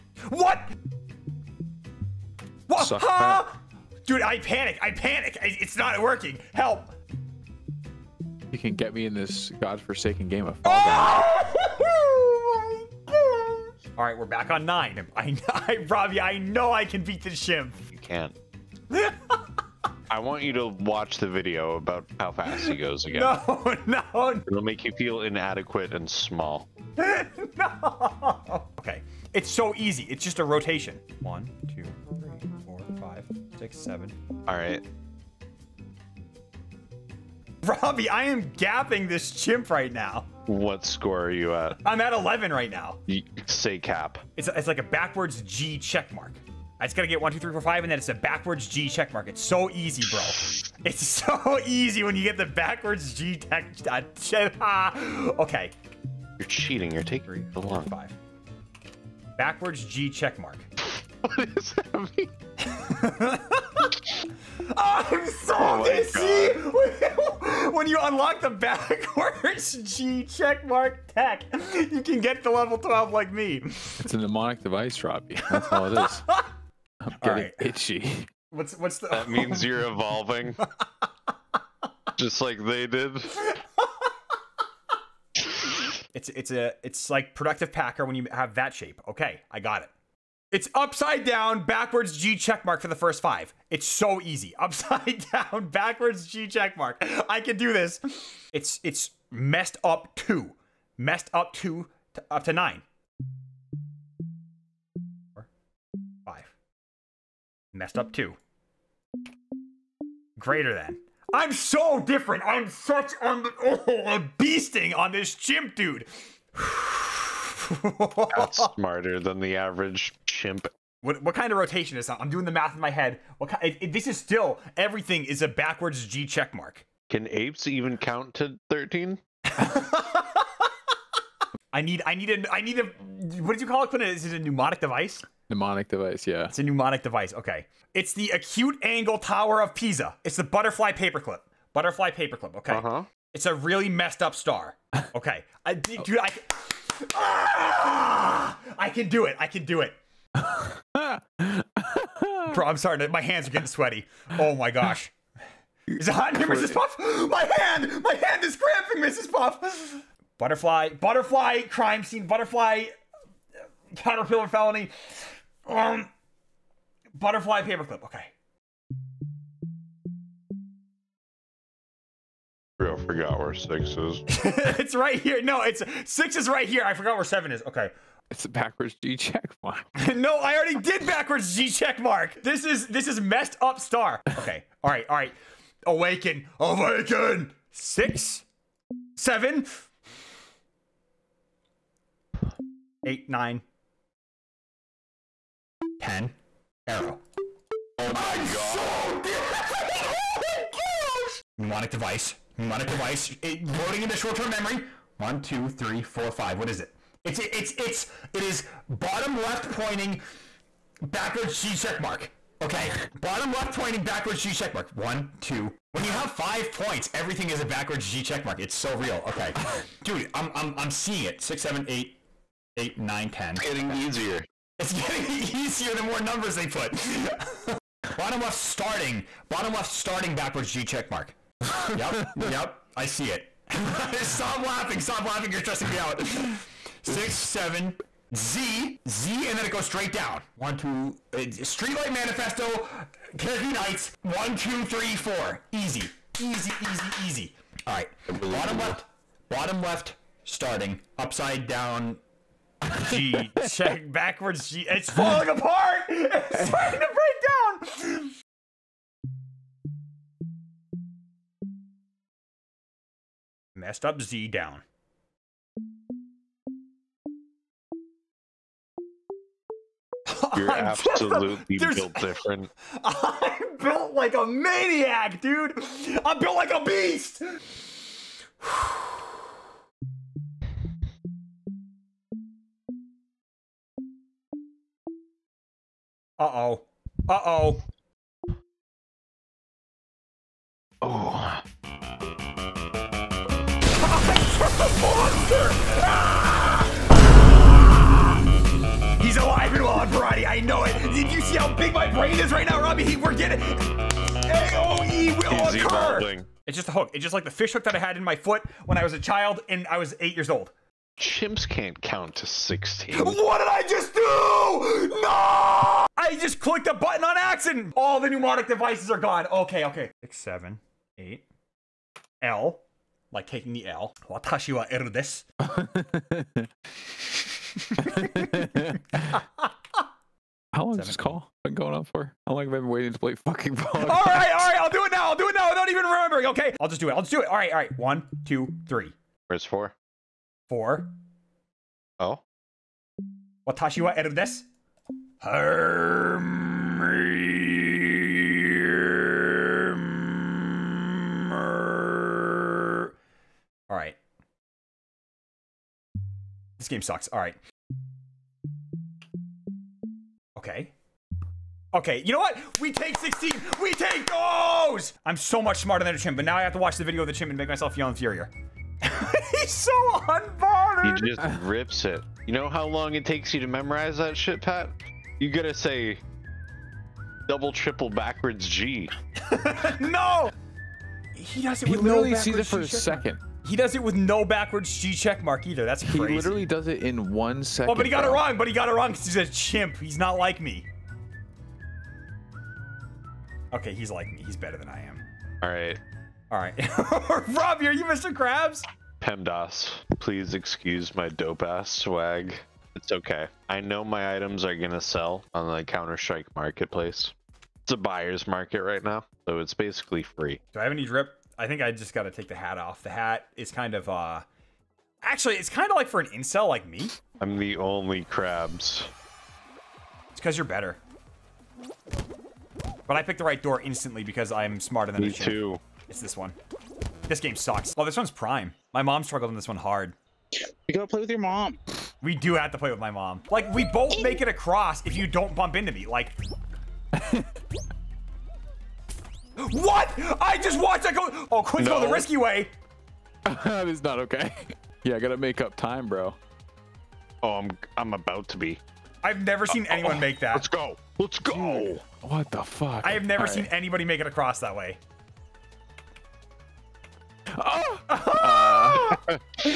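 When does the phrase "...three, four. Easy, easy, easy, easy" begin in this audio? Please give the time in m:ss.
4:04.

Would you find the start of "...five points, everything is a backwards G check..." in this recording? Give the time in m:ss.
3:36.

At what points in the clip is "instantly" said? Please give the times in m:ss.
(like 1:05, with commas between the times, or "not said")
7:03.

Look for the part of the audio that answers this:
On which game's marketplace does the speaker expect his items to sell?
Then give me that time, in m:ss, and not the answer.
6:45.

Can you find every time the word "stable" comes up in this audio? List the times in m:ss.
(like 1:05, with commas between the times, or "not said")
not said.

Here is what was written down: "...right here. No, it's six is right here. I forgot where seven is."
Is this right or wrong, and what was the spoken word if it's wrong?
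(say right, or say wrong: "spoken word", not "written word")
right.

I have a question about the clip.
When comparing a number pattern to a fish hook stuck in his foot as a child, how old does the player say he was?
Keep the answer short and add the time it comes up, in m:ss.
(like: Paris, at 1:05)
8, at 5:09.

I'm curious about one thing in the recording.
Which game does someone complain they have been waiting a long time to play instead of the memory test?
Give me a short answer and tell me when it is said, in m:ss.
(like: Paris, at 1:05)
Pog, at 5:33.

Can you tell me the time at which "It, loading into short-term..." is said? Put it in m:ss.
3:23.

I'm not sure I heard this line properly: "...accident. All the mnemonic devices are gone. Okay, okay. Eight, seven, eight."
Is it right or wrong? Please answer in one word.
wrong.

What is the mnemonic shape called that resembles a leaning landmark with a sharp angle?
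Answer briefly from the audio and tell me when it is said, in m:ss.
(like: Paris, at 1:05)
acute angle tower of Pisa, at 2:17.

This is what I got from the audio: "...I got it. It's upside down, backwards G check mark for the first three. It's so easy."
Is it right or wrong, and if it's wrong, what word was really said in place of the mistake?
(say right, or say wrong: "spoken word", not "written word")
wrong: "five", not "three".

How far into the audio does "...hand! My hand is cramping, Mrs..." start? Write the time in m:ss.
2:37.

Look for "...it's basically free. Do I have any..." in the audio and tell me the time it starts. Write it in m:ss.
6:49.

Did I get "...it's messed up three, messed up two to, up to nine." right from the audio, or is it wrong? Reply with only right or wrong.
wrong.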